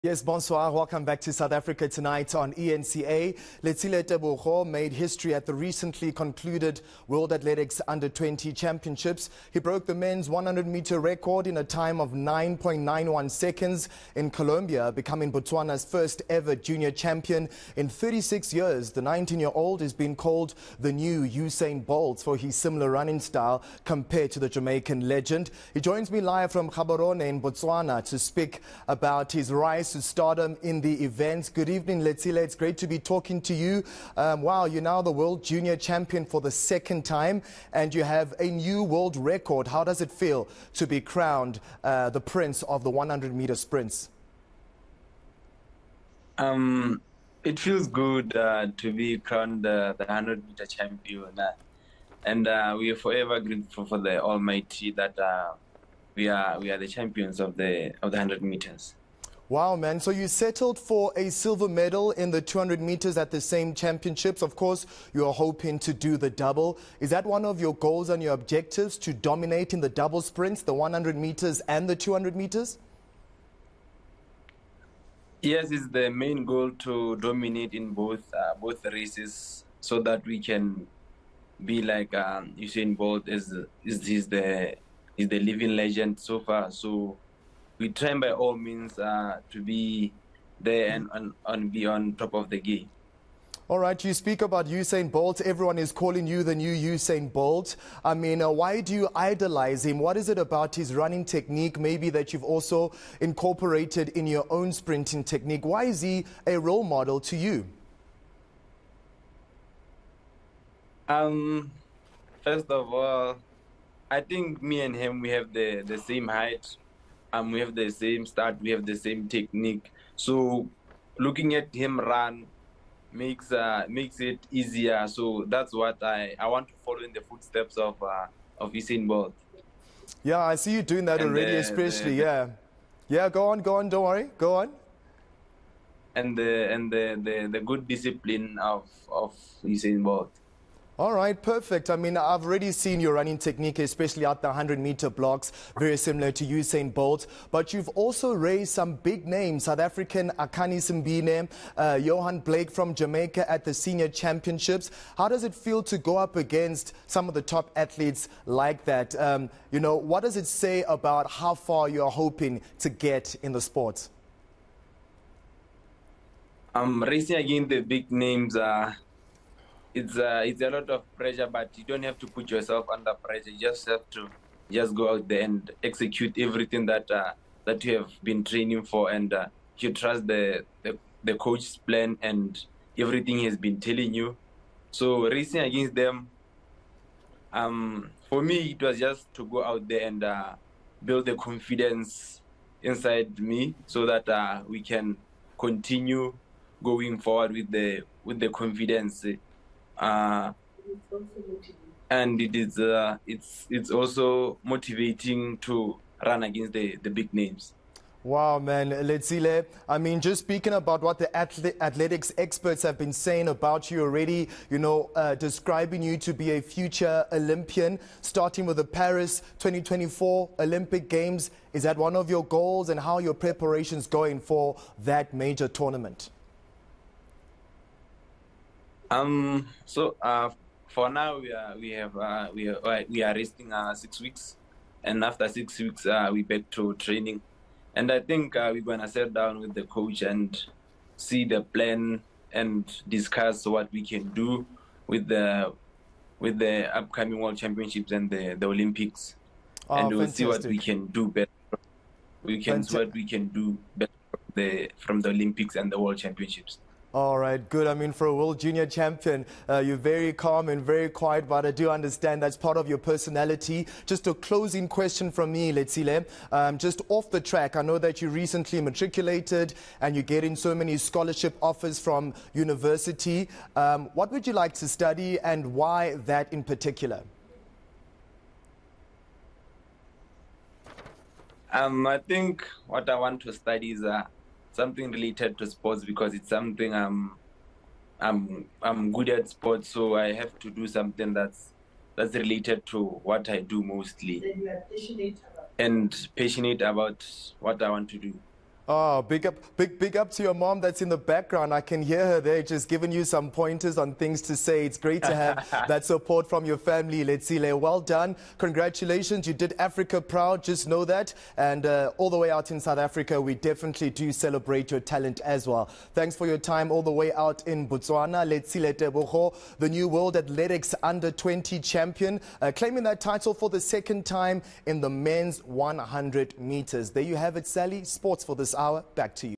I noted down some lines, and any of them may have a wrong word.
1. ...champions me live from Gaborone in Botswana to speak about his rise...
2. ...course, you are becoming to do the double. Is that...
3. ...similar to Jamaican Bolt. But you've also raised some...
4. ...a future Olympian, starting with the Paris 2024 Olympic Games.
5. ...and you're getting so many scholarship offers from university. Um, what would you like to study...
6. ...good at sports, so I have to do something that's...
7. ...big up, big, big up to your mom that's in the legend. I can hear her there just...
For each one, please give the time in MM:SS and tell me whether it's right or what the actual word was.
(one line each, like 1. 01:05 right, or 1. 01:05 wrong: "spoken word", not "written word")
1. 00:25 wrong: "joins", not "champions"
2. 01:04 wrong: "hoping", not "becoming"
3. 02:25 wrong: "Usain", not "Jamaican"
4. 03:36 right
5. 04:29 right
6. 04:49 right
7. 04:59 wrong: "background", not "legend".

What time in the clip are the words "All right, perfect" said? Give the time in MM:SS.
02:21.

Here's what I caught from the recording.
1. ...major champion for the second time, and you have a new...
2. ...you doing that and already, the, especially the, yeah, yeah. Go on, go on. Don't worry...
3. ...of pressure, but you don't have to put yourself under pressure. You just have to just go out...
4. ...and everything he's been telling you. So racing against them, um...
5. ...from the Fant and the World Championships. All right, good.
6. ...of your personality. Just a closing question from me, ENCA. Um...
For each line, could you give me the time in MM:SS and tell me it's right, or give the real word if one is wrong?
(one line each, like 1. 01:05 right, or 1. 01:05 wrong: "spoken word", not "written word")
1. 00:35 wrong: "junior", not "major"
2. 02:10 right
3. 02:50 right
4. 03:02 right
5. 04:14 wrong: "Olympics", not "Fant"
6. 04:22 wrong: "Letsile", not "ENCA".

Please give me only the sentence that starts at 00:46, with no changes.
Um, it feels good uh, to be crowned uh, the 100 meter champion.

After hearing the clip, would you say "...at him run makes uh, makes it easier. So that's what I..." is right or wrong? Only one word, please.
right.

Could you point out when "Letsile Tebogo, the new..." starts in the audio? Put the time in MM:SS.
05:18.